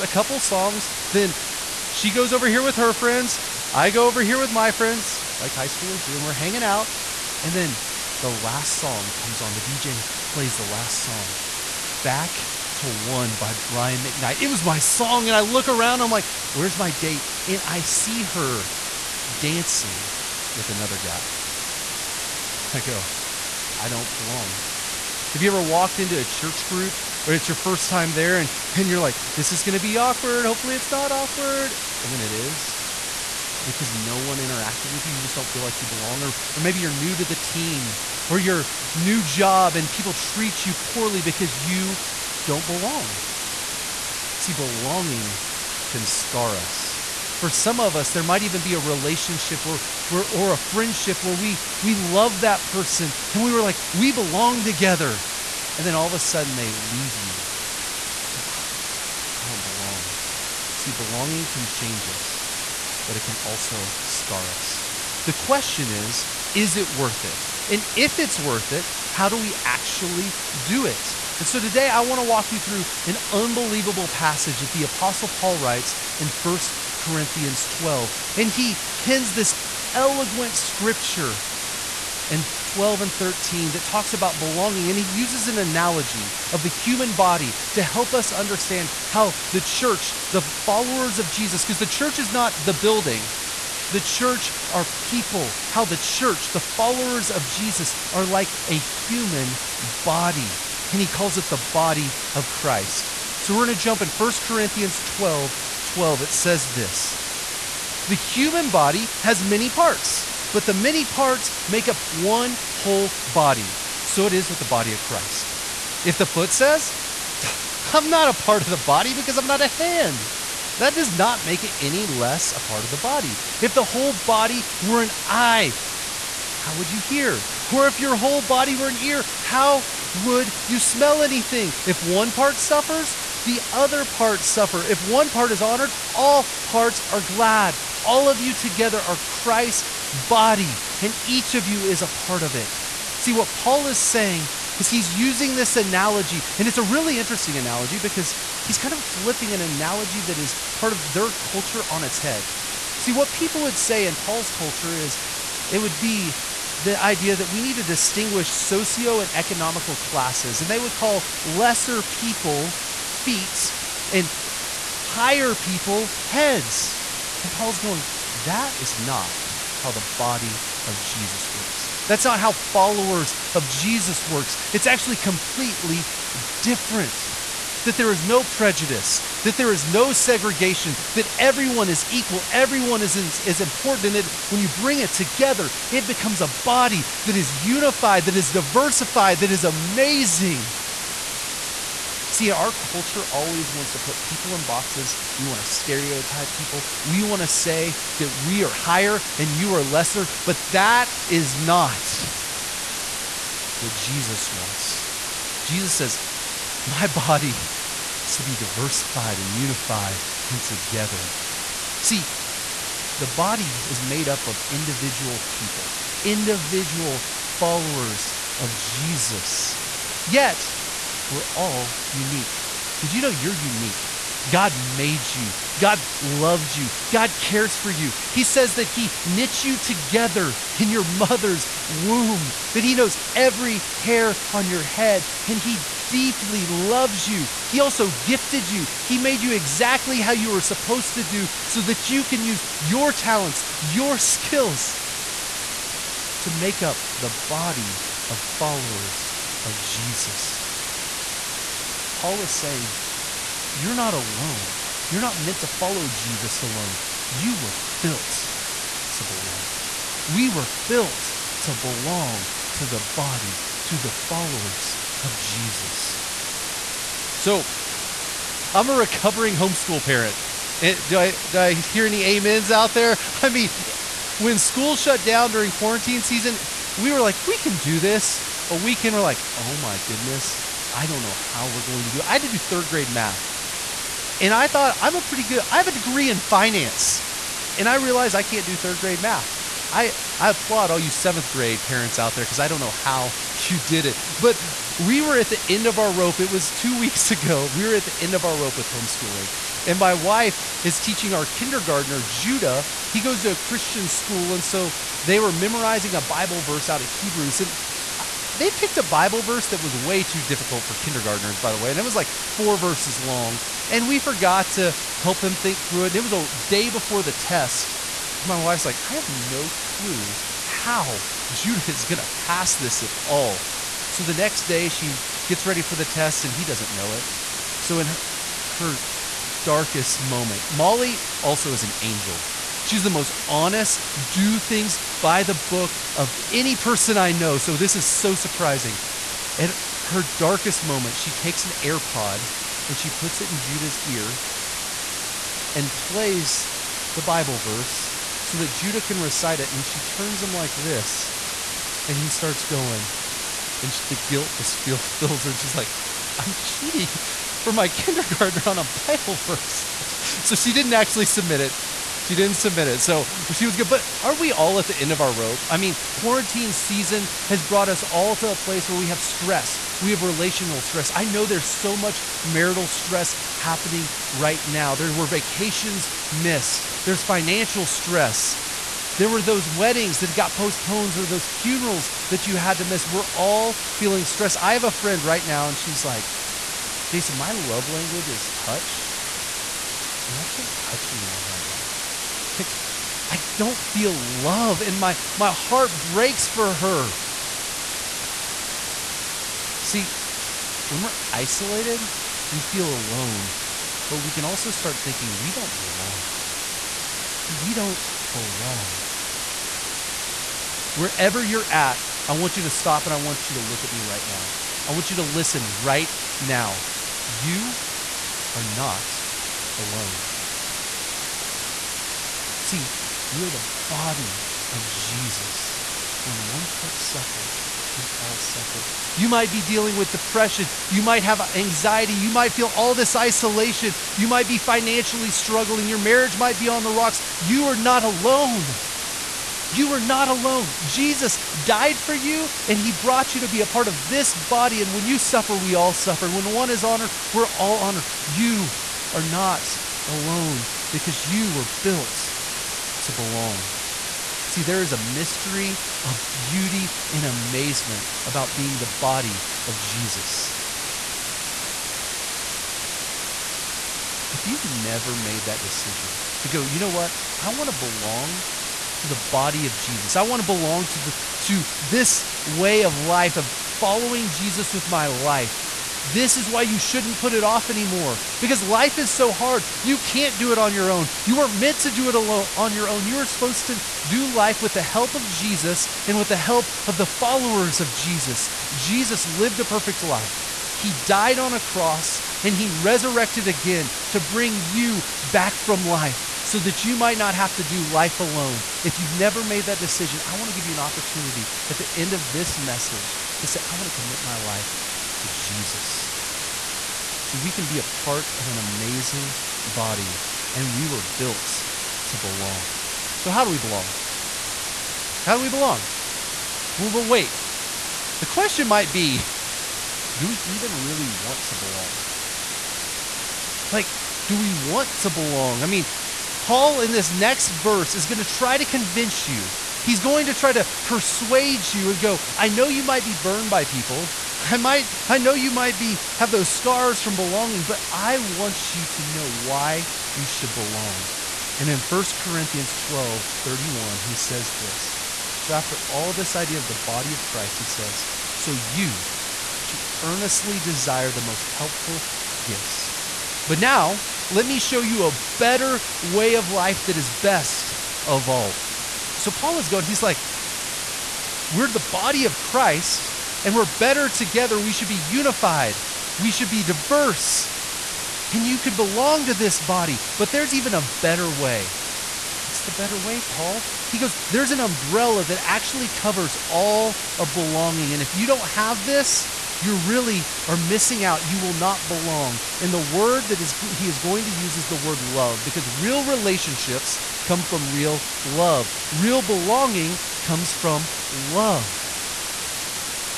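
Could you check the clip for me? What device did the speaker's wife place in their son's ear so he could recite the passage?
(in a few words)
AirPod.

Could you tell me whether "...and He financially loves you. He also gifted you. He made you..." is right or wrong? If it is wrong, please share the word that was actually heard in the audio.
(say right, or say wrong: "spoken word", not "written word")
wrong: "deeply", not "financially".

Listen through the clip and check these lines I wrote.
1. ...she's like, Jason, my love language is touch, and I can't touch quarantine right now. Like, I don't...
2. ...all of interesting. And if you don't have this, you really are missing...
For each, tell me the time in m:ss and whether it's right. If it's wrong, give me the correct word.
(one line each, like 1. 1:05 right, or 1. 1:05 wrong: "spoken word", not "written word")
1. 6:25 wrong: "anyone", not "quarantine"
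2. 9:36 wrong: "belonging", not "interesting".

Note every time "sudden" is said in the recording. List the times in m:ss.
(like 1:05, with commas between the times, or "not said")
0:56.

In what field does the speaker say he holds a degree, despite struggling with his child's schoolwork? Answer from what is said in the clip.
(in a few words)
finance.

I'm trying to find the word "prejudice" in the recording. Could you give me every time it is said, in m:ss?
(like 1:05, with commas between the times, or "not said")
2:58.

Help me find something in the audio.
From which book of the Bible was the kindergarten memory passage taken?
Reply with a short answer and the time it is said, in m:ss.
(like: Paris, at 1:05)
Hebrews, at 5:07.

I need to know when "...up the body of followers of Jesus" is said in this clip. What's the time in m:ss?
4:06.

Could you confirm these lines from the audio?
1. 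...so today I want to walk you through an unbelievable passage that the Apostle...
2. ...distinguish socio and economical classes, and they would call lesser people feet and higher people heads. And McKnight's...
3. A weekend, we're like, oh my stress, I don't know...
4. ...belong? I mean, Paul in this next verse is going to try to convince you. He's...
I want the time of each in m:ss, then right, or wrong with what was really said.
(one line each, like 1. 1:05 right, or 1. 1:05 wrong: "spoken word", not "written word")
1. 1:11 right
2. 2:37 wrong: "Paul", not "McKnight"
3. 4:38 wrong: "goodness", not "stress"
4. 8:45 right.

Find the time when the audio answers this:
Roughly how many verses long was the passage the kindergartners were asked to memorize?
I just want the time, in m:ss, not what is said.
5:12.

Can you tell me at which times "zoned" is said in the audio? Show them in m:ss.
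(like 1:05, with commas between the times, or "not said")
not said.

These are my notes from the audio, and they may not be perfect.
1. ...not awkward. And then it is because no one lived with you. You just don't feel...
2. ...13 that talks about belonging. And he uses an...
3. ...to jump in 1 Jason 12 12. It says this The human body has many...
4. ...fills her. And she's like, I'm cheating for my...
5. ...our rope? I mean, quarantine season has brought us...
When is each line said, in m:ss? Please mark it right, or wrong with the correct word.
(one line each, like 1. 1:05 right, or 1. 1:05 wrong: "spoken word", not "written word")
1. 0:30 wrong: "interacted", not "lived"
2. 1:23 right
3. 1:43 wrong: "Corinthians", not "Jason"
4. 5:54 right
5. 6:05 right.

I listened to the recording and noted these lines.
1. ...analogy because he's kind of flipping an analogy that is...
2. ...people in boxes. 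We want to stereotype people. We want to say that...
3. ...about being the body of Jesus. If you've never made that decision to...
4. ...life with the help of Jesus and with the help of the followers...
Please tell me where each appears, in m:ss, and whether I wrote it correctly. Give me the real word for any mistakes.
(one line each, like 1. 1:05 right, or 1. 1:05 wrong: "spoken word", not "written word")
1. 2:27 right
2. 3:14 right
3. 7:38 right
4. 8:04 right.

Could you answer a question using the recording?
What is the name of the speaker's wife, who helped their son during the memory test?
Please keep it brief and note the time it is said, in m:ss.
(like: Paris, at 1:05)
Molly, at 5:30.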